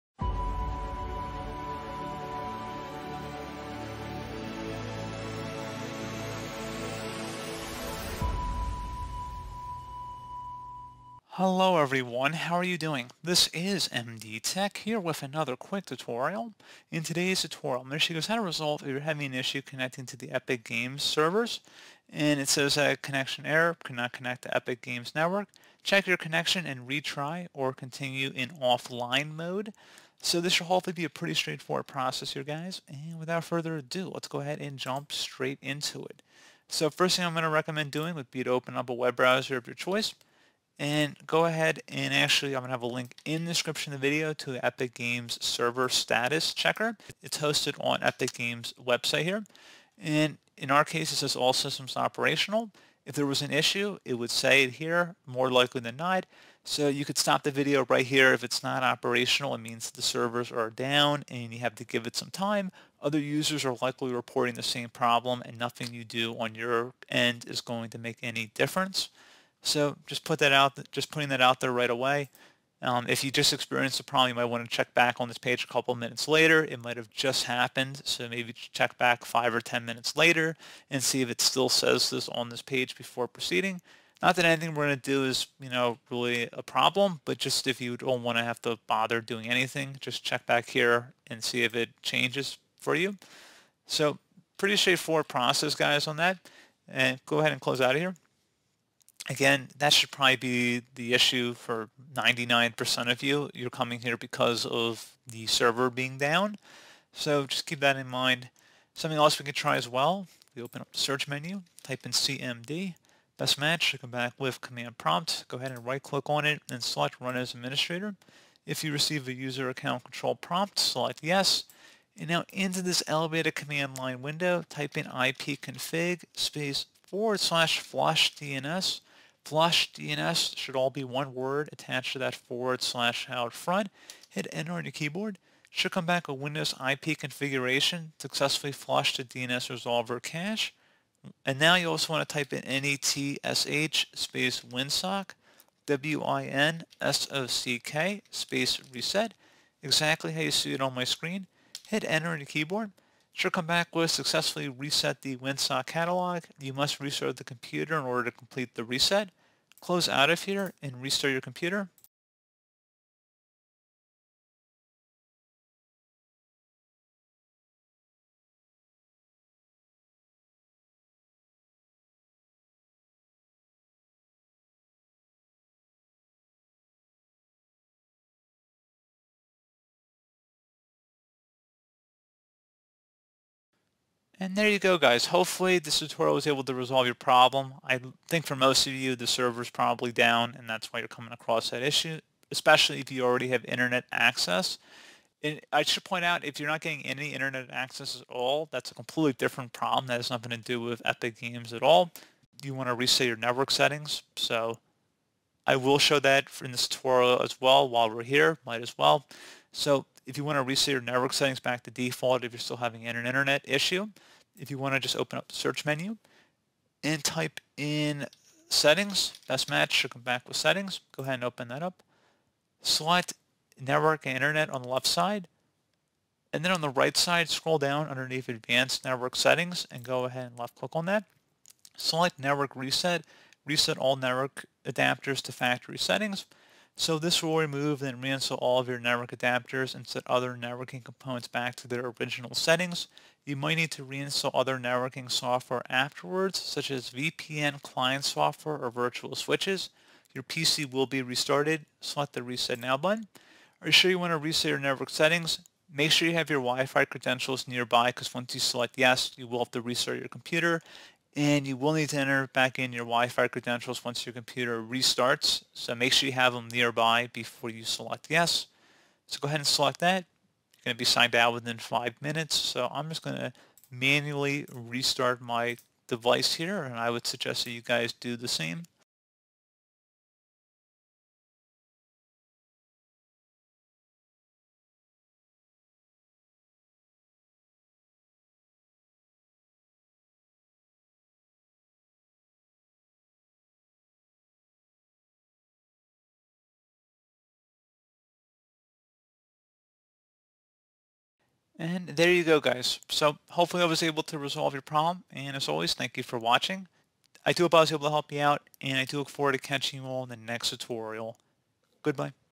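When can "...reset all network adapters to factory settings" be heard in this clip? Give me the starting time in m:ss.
3:53.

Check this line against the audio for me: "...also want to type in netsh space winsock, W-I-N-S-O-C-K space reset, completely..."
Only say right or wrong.
wrong.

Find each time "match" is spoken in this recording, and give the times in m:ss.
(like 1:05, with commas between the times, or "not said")
1:53, 3:39.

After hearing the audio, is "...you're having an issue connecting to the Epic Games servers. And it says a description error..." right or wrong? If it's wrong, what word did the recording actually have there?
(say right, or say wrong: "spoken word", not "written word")
wrong: "connection", not "description".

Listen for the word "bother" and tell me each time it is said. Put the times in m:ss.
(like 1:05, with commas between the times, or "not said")
1:28.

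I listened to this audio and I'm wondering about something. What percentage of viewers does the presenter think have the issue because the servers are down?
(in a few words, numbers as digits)
99%.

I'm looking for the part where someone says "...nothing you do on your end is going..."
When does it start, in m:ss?
1:05.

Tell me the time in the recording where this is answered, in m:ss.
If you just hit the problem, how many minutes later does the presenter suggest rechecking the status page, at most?
1:19.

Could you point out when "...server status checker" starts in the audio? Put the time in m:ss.
0:45.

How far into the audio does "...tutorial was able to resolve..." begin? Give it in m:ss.
3:05.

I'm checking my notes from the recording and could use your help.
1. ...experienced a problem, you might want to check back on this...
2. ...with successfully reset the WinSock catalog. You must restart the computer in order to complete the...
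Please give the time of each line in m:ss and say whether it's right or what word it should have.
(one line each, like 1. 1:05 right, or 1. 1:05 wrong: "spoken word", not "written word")
1. 1:13 right
2. 2:33 right.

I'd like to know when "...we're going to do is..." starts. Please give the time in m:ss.
1:24.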